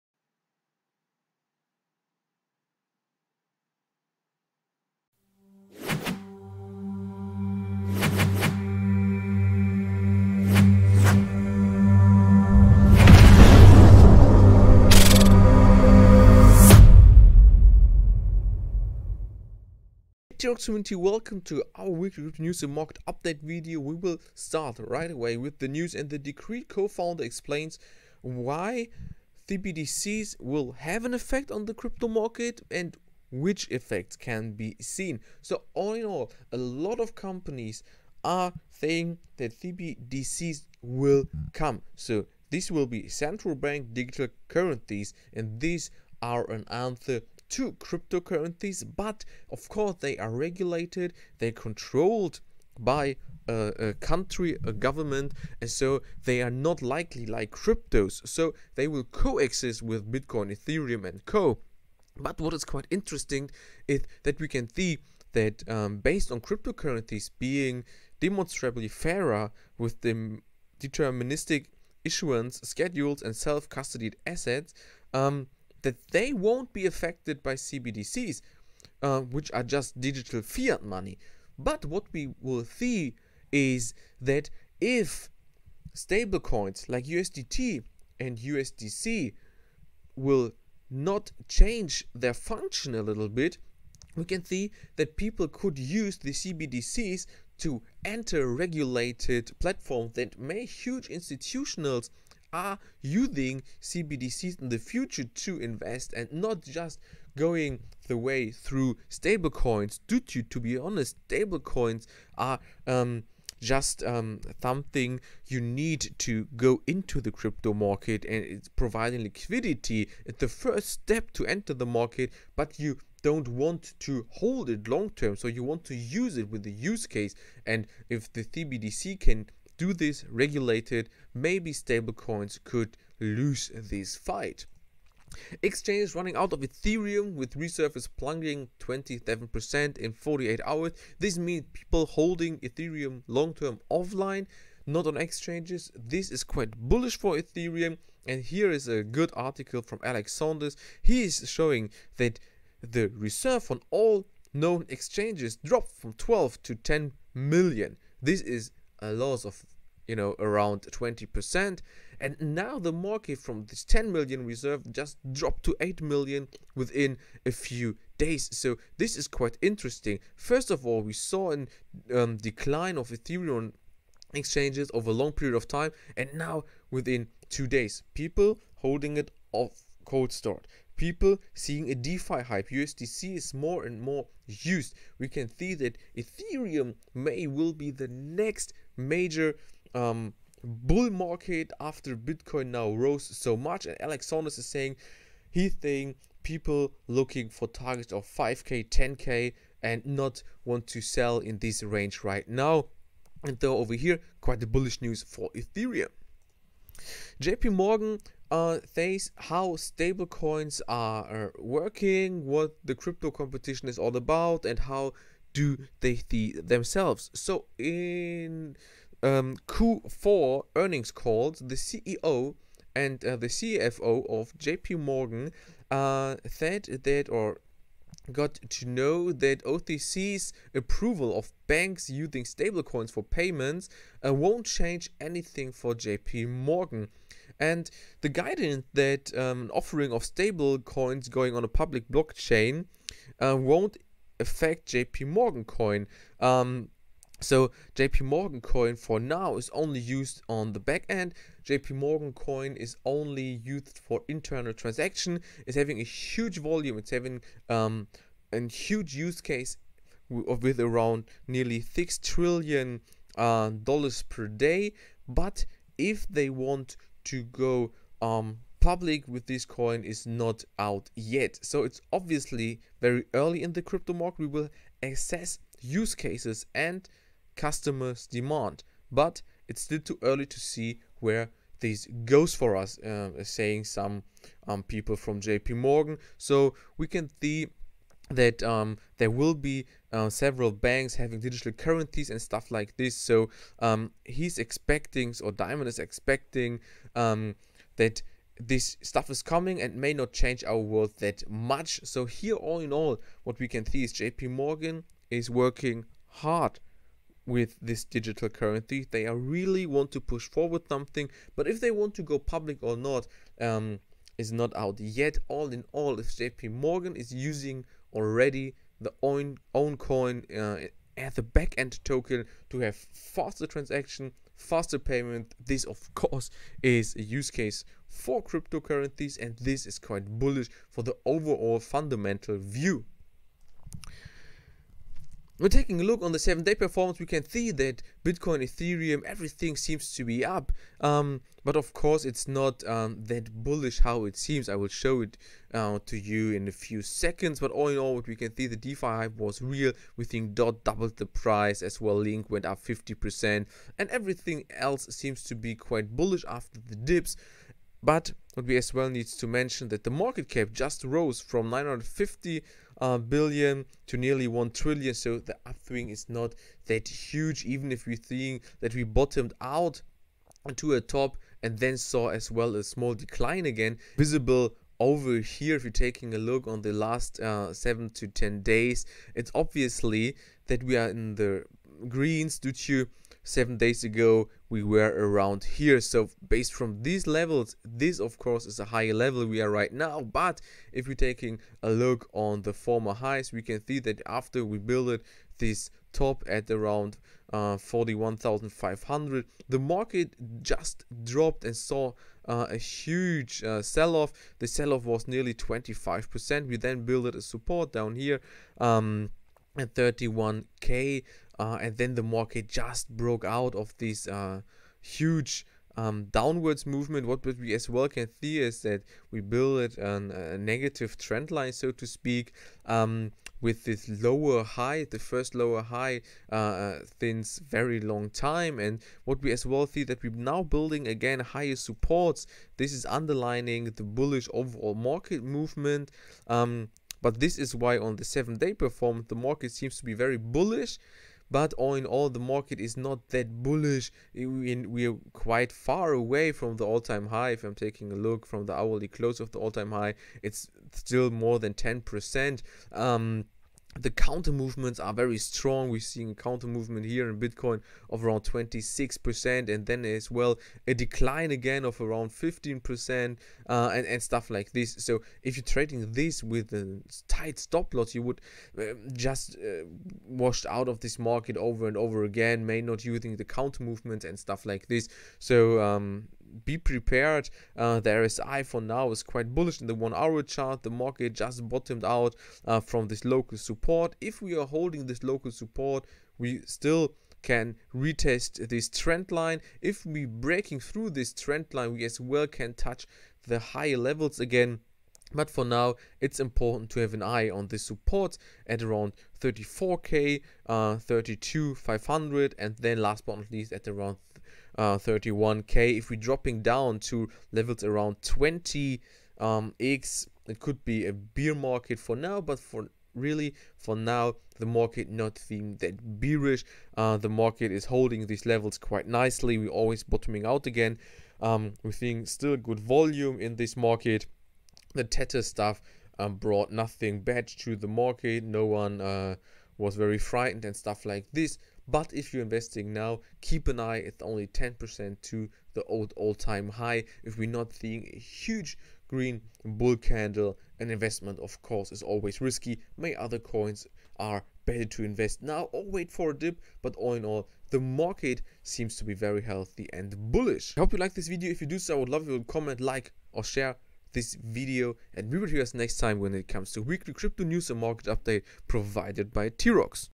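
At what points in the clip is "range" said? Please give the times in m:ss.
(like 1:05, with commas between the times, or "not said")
3:21.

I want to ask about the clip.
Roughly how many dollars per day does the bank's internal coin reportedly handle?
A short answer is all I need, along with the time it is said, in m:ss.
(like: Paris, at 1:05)
nearly six trillion, at 4:21.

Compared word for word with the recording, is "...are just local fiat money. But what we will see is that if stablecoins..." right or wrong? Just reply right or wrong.
wrong.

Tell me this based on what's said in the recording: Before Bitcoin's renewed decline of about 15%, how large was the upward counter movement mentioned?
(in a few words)
26%.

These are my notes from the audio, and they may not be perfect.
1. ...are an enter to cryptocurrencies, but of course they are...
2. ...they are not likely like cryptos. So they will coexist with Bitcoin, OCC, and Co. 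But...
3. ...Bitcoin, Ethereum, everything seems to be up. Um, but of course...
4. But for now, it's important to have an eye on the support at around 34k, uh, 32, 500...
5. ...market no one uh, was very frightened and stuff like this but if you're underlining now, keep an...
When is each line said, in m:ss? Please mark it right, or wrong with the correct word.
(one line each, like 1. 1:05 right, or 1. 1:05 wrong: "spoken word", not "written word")
1. 0:46 wrong: "answer", not "enter"
2. 0:56 wrong: "Ethereum", not "OCC"
3. 5:38 right
4. 8:15 right
5. 8:47 wrong: "investing", not "underlining".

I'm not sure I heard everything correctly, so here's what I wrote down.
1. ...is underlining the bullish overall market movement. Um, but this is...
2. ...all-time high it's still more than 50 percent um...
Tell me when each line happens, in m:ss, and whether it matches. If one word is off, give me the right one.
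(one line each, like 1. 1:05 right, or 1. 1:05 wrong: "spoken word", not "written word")
1. 7:12 right
2. 7:29 wrong: "10", not "50".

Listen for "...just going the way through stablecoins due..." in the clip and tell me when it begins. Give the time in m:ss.
1:46.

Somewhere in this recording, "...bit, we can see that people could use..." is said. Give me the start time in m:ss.
1:33.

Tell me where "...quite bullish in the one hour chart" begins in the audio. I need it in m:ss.
7:59.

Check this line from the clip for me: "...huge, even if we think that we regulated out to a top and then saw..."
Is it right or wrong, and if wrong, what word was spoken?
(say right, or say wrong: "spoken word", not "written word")
wrong: "bottomed", not "regulated".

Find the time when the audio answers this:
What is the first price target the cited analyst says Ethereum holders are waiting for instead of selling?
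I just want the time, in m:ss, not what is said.
3:18.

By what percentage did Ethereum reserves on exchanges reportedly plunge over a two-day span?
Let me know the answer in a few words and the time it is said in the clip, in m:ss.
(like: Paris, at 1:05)
27%, at 2:18.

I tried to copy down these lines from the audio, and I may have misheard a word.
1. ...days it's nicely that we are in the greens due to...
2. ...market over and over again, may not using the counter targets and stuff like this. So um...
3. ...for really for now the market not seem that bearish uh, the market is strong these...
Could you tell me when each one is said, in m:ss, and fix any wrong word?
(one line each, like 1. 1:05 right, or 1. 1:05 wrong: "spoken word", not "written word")
1. 6:18 wrong: "obviously", not "nicely"
2. 7:51 wrong: "movements", not "targets"
3. 8:32 wrong: "holding", not "strong".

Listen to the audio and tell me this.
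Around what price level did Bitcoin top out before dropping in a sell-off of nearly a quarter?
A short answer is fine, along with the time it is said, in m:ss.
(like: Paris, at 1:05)
41,500, at 6:37.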